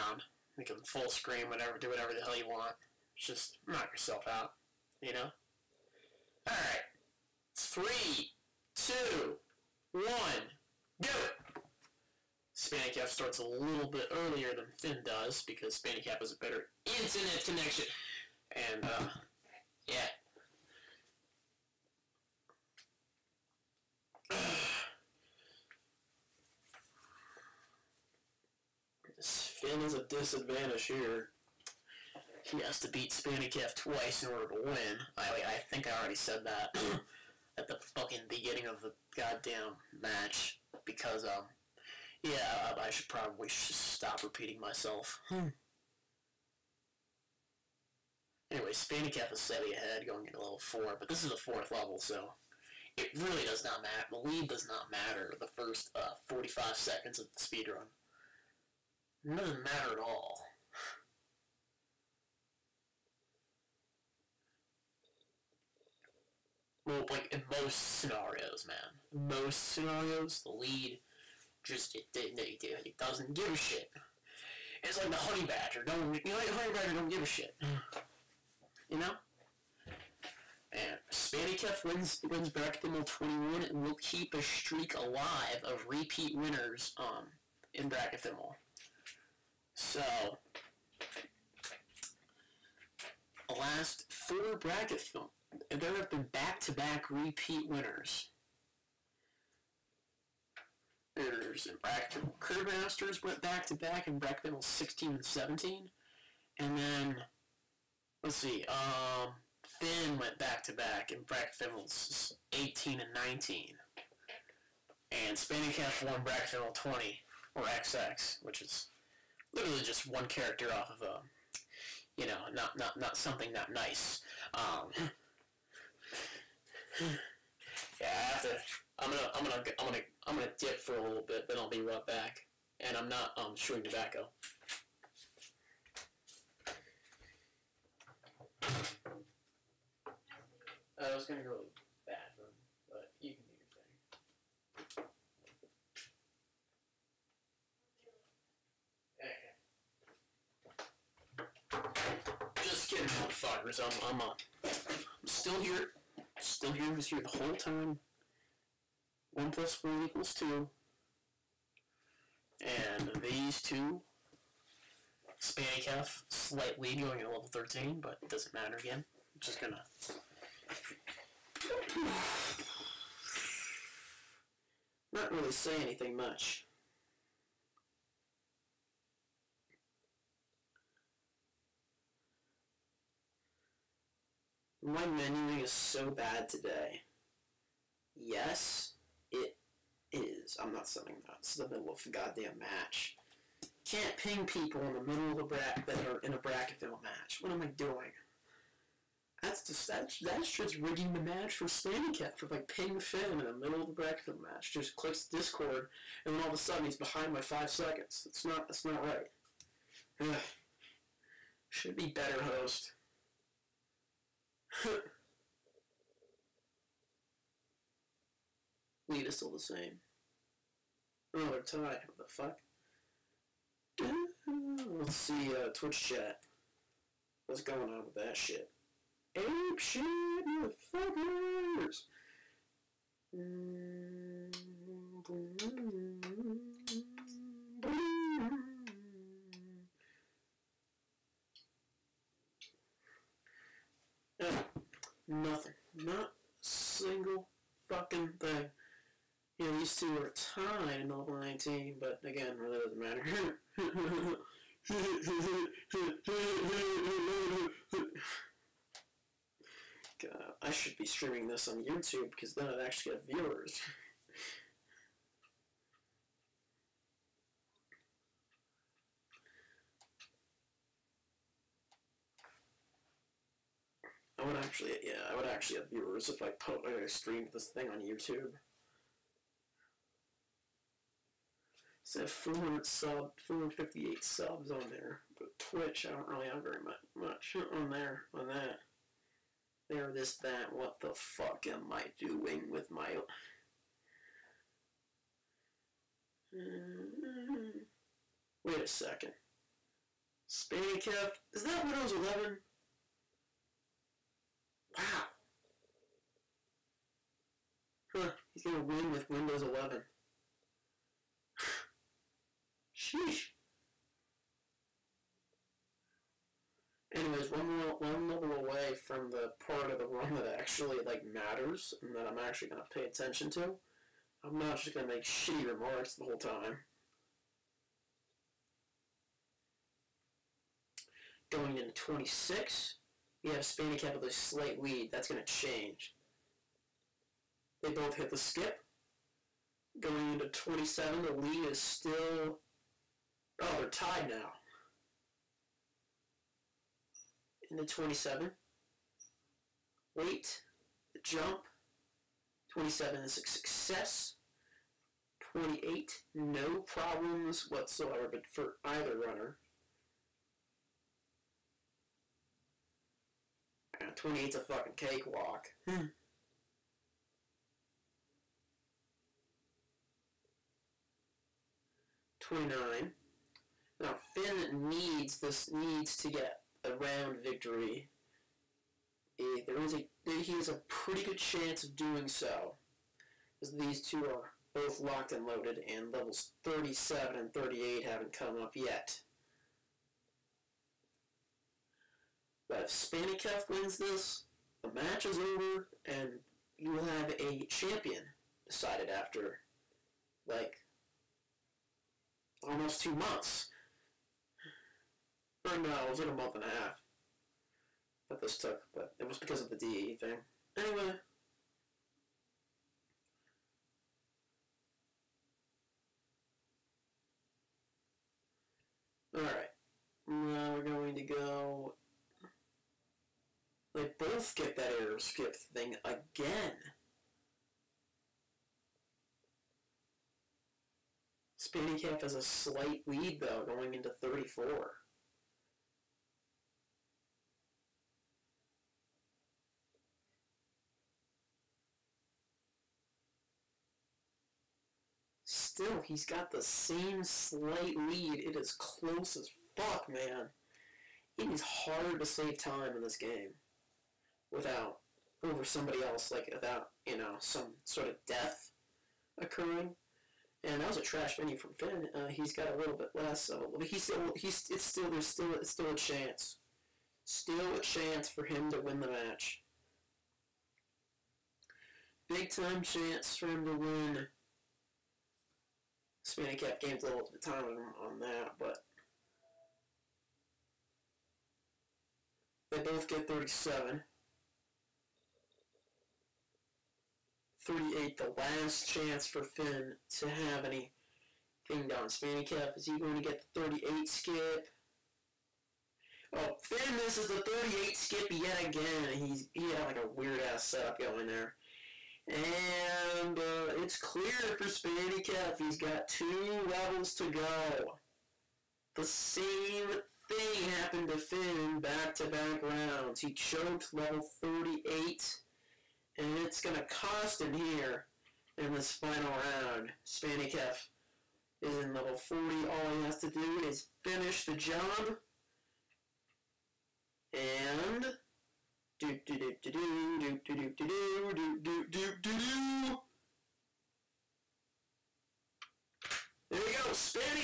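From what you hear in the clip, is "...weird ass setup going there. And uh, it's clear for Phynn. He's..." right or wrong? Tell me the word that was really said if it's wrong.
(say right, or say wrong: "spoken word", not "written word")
wrong: "Spanikef", not "Phynn".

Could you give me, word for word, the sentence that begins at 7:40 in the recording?
And that was a trash mini from Phynn.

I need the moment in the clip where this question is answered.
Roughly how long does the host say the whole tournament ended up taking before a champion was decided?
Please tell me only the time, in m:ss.
6:46.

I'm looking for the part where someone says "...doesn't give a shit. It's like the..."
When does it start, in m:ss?
1:12.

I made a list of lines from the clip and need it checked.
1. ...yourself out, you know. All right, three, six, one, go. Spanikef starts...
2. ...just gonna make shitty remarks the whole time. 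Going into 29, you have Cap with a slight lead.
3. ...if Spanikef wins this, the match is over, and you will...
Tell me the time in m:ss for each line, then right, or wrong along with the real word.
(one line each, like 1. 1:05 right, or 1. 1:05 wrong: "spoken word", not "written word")
1. 0:03 wrong: "two", not "six"
2. 5:24 wrong: "26", not "29"
3. 6:32 right.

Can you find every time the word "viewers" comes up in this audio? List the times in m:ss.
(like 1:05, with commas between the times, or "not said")
4:23, 4:35.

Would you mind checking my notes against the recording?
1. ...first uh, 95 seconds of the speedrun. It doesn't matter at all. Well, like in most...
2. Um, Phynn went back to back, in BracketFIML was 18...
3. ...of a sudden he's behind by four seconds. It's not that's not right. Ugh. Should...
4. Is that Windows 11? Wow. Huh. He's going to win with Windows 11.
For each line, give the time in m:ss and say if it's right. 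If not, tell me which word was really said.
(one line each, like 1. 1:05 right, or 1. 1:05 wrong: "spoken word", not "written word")
1. 0:55 wrong: "45", not "95"
2. 1:48 right
3. 3:26 wrong: "five", not "four"
4. 5:01 right.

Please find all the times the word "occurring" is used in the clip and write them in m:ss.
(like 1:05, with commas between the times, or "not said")
7:39.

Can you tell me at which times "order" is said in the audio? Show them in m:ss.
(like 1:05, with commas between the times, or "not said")
0:34.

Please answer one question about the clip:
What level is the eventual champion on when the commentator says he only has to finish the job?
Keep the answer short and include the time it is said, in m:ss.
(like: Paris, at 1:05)
40, at 8:41.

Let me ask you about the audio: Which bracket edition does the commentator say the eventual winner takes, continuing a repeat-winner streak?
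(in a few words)
21.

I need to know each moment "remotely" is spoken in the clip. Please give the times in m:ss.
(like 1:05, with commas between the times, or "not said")
not said.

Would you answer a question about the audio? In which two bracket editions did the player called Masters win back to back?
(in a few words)
16 and 17.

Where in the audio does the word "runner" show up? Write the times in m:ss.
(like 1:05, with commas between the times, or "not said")
5:59.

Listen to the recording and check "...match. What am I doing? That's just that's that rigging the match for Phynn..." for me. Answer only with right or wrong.
wrong.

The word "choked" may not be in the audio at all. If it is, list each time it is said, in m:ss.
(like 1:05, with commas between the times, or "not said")
8:33.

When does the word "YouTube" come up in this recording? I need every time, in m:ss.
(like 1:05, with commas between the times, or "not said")
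4:21, 4:38.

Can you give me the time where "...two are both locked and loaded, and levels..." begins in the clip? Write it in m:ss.
6:24.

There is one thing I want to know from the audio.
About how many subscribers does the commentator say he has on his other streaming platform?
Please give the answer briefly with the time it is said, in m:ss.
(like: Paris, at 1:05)
458, at 4:43.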